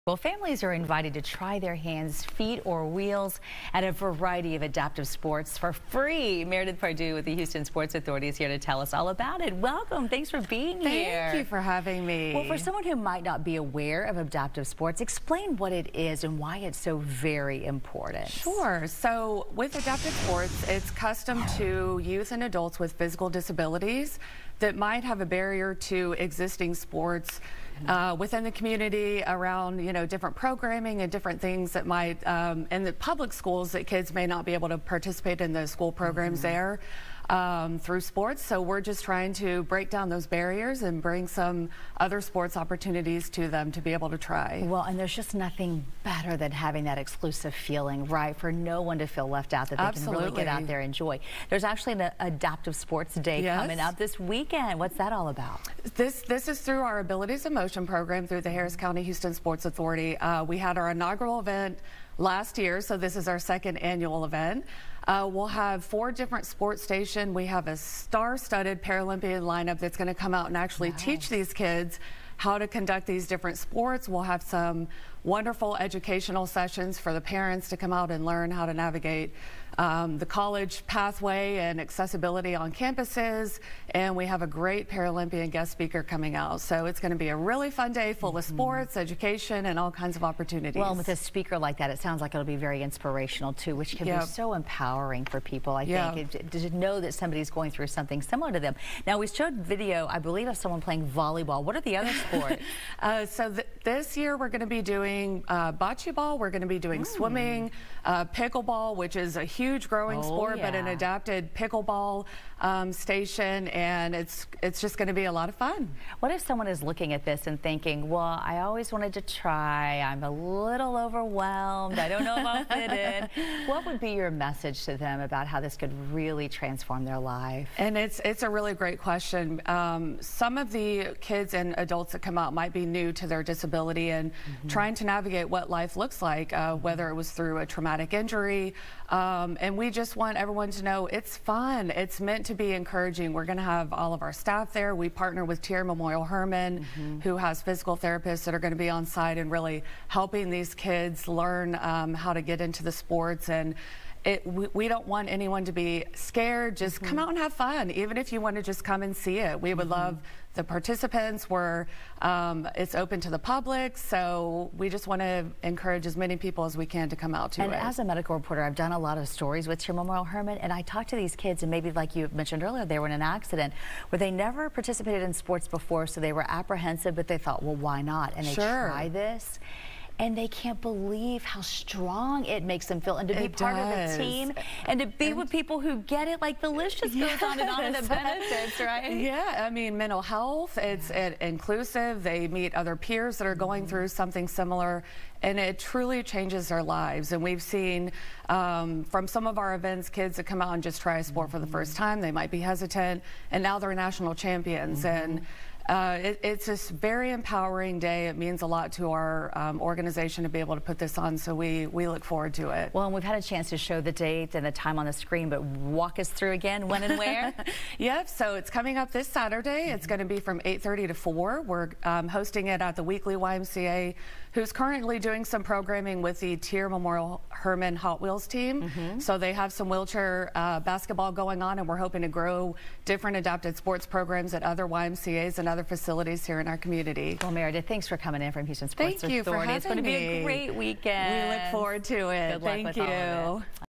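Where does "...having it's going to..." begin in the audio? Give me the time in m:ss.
3:59.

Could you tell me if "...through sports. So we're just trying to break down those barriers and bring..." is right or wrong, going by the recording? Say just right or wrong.
right.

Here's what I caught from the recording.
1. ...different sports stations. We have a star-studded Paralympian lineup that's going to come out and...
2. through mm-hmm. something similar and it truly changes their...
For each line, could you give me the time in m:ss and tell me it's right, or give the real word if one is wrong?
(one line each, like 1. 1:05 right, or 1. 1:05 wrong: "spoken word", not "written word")
1. 1:06 right
2. 3:13 right.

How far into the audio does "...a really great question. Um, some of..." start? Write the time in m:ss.
2:08.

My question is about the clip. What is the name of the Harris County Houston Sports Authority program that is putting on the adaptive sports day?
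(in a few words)
Abilities in Motion.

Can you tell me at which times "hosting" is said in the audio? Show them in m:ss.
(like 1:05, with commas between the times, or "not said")
3:42.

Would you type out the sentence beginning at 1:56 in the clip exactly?
What if someone is looking at this and thinking, well, I always wanted to try.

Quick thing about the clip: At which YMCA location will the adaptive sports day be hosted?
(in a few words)
Weekley YMCA.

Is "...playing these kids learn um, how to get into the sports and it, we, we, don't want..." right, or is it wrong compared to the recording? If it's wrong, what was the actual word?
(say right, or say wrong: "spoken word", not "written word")
wrong: "helping", not "playing".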